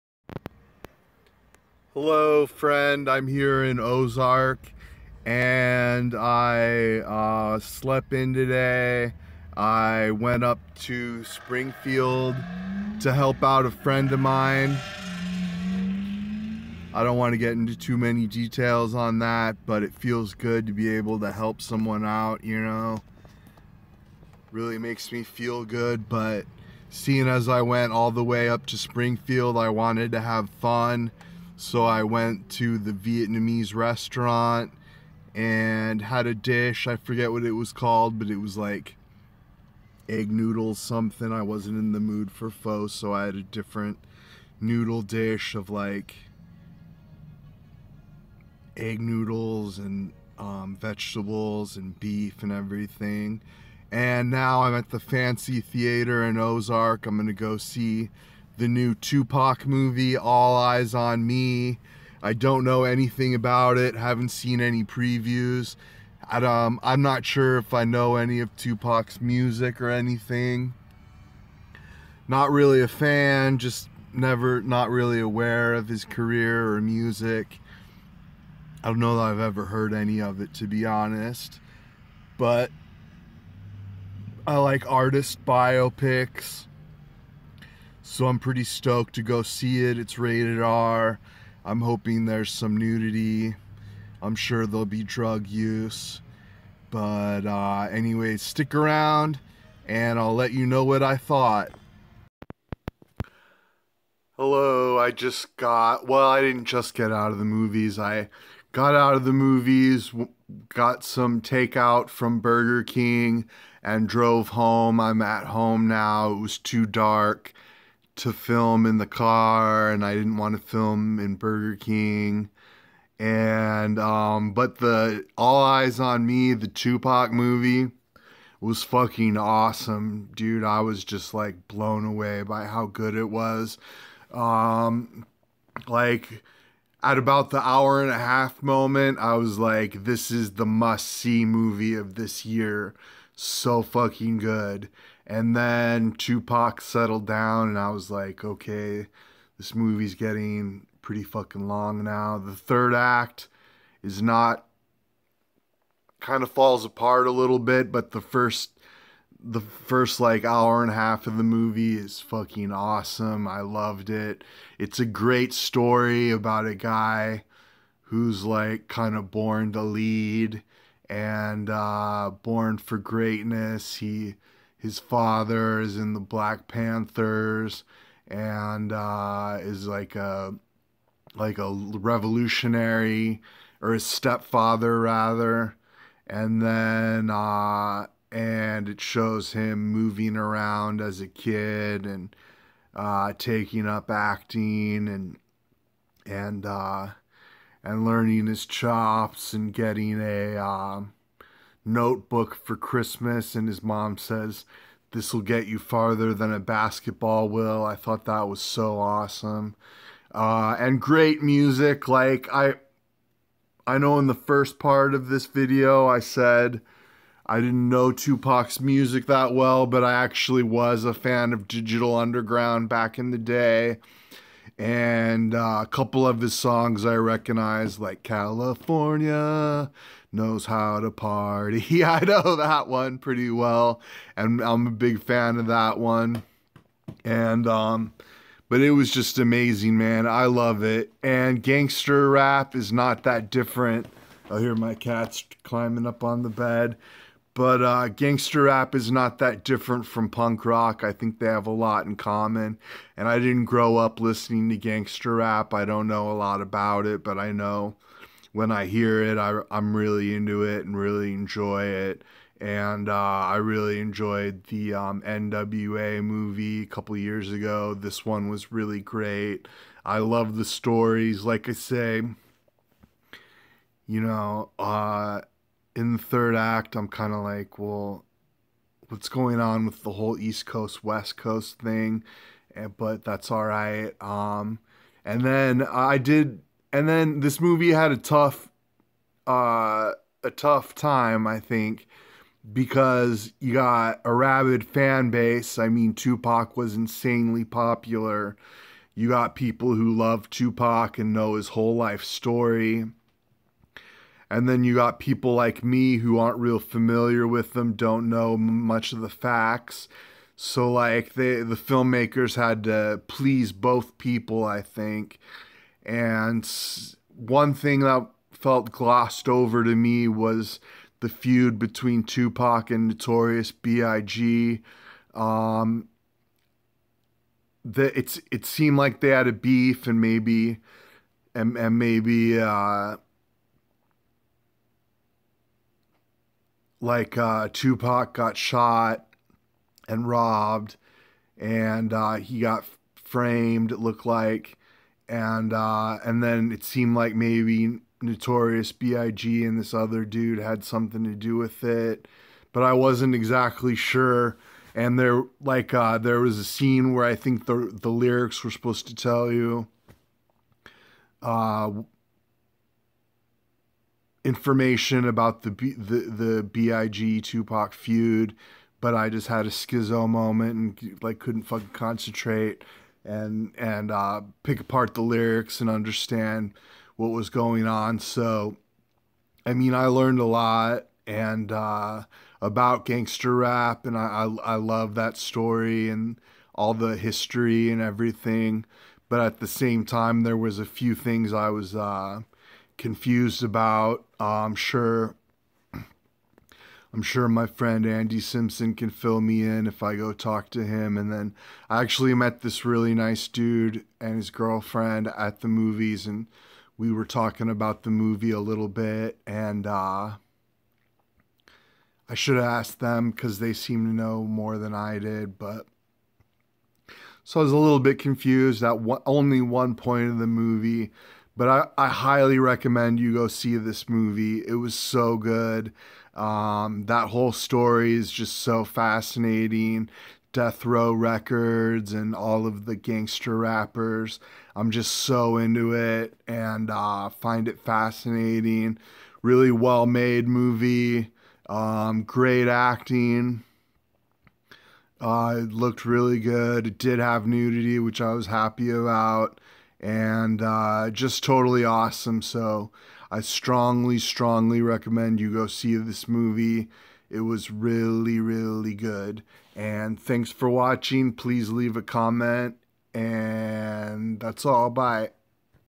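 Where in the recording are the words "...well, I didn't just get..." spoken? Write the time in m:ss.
1:46.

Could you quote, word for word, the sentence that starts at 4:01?
And gangster rap is not that different.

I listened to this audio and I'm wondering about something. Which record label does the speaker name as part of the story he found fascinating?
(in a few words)
Death Row Records.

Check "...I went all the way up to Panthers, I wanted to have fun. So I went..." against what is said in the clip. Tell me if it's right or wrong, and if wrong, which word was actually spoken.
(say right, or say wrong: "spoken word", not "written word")
wrong: "Springfield", not "Panthers".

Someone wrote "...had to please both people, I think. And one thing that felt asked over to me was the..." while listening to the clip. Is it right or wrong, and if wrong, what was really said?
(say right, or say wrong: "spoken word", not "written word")
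wrong: "glossed", not "asked".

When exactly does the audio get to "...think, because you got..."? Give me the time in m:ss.
4:51.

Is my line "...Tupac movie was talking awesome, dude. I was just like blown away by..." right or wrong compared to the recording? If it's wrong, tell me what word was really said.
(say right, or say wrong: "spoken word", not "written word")
wrong: "fucking", not "talking".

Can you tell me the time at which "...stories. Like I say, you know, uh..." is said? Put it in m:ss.
4:30.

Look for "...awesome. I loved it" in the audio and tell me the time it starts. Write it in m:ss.
2:42.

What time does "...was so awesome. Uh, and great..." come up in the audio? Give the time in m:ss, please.
3:28.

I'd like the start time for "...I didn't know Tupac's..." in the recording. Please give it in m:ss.
3:37.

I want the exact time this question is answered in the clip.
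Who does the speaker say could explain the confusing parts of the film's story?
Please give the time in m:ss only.
6:38.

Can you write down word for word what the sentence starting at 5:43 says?
It looked like, and uh, and then it seemed like maybe Notorious B.I.G.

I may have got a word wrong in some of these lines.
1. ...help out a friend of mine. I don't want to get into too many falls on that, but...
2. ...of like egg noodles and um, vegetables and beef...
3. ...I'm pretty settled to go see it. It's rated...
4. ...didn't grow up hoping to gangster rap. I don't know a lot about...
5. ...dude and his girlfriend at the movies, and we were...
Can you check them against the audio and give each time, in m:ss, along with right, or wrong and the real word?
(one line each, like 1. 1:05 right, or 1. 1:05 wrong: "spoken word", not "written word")
1. 0:13 wrong: "details", not "falls"
2. 0:45 right
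3. 1:28 wrong: "stoked", not "settled"
4. 4:13 wrong: "listening", not "hoping"
5. 6:43 right.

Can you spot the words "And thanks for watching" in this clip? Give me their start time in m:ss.
7:39.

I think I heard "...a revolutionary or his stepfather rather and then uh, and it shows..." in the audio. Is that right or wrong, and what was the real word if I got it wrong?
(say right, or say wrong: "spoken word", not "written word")
right.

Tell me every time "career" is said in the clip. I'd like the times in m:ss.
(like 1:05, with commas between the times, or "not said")
1:16.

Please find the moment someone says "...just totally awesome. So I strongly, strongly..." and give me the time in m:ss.
7:31.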